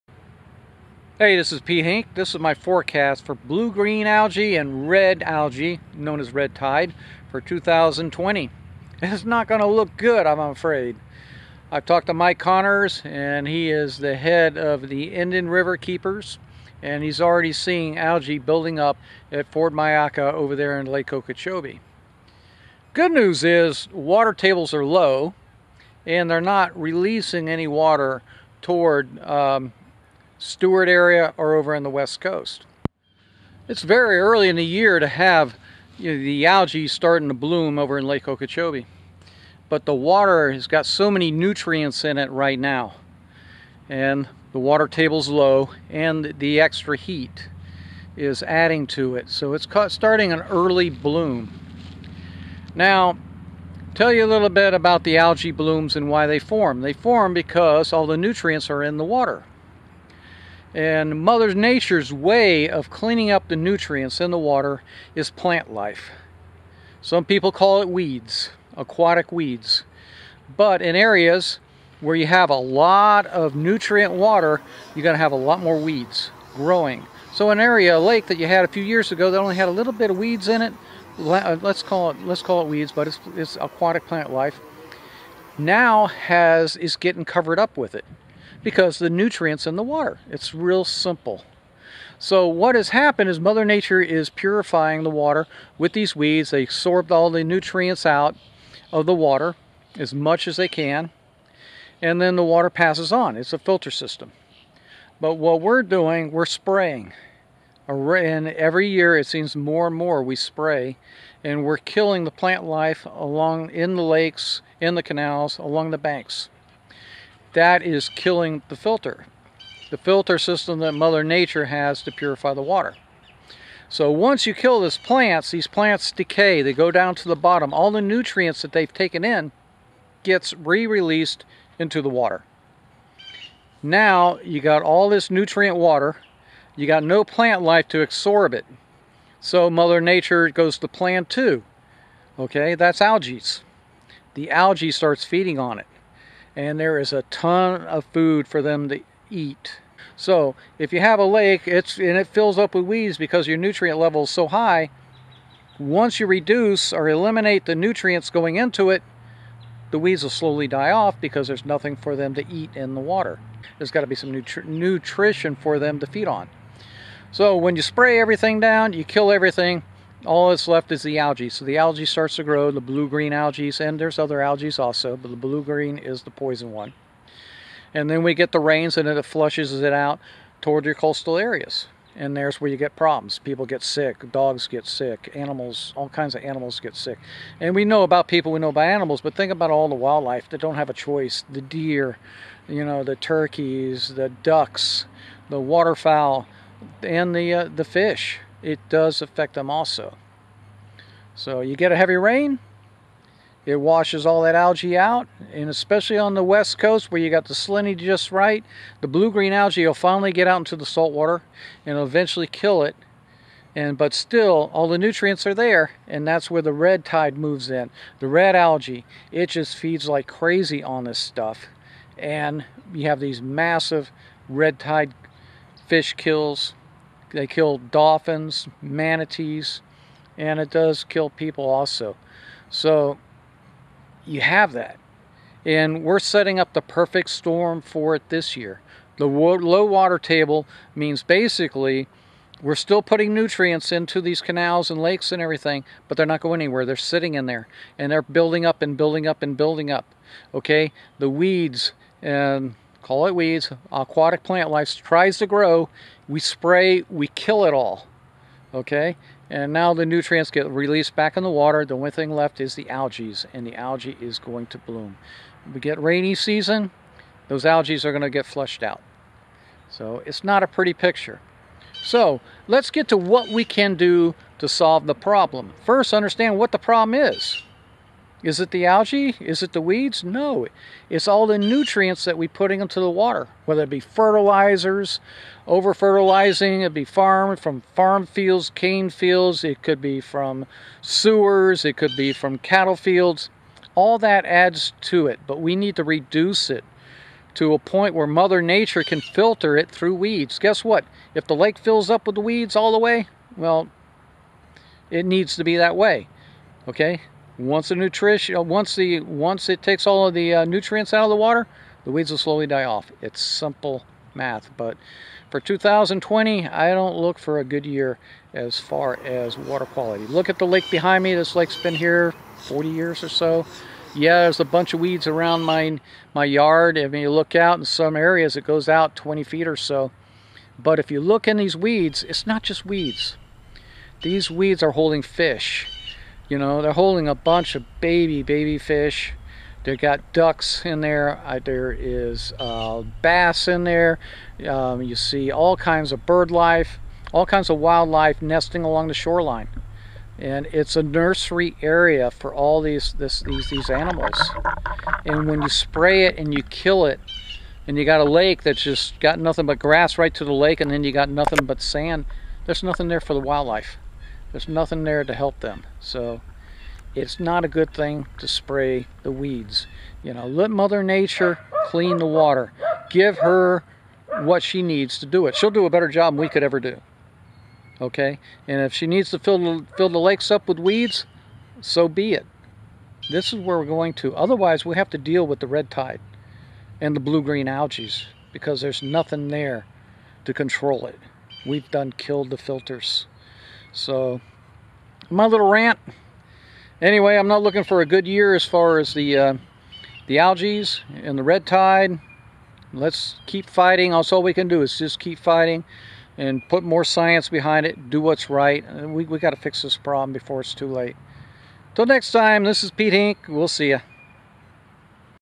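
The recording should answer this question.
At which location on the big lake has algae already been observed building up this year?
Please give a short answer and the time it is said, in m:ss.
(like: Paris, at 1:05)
Port Mayaca, at 0:19.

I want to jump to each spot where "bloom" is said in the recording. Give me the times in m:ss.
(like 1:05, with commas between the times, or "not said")
0:37, 0:50, 0:55, 4:24.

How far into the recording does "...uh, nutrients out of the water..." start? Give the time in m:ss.
5:10.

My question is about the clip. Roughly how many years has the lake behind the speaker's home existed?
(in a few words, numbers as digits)
40 years.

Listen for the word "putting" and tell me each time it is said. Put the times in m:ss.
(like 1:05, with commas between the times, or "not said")
4:03, 4:42.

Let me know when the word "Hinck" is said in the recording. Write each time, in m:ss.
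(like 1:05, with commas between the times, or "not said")
0:01, 6:53.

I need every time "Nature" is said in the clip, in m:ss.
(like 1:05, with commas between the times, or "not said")
1:01, 1:33, 2:01, 2:19, 4:58, 6:11.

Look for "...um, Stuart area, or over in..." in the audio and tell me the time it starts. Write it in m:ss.
0:29.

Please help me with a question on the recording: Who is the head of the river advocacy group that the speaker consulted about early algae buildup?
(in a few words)
Mike Connors.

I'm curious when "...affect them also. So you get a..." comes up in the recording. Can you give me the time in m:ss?
3:19.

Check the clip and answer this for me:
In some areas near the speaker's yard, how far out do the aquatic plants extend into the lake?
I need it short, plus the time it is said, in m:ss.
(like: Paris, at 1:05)
20 feet, at 5:29.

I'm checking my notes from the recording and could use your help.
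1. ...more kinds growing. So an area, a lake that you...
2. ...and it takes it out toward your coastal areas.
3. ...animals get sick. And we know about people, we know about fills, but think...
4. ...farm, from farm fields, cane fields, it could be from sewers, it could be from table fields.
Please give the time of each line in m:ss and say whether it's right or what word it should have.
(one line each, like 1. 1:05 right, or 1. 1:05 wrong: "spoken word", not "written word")
1. 1:15 wrong: "weeds", not "kinds"
2. 2:58 wrong: "flushes", not "takes"
3. 3:06 wrong: "animals", not "fills"
4. 4:47 wrong: "cattle", not "table".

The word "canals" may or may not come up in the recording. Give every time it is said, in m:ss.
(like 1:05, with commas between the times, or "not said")
1:55, 4:04.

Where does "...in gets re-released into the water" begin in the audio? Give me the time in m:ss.
2:09.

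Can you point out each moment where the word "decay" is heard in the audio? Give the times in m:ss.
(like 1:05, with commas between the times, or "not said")
2:06.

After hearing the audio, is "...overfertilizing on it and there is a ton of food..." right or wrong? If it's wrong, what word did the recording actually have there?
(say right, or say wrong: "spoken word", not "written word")
wrong: "feeding", not "overfertilizing".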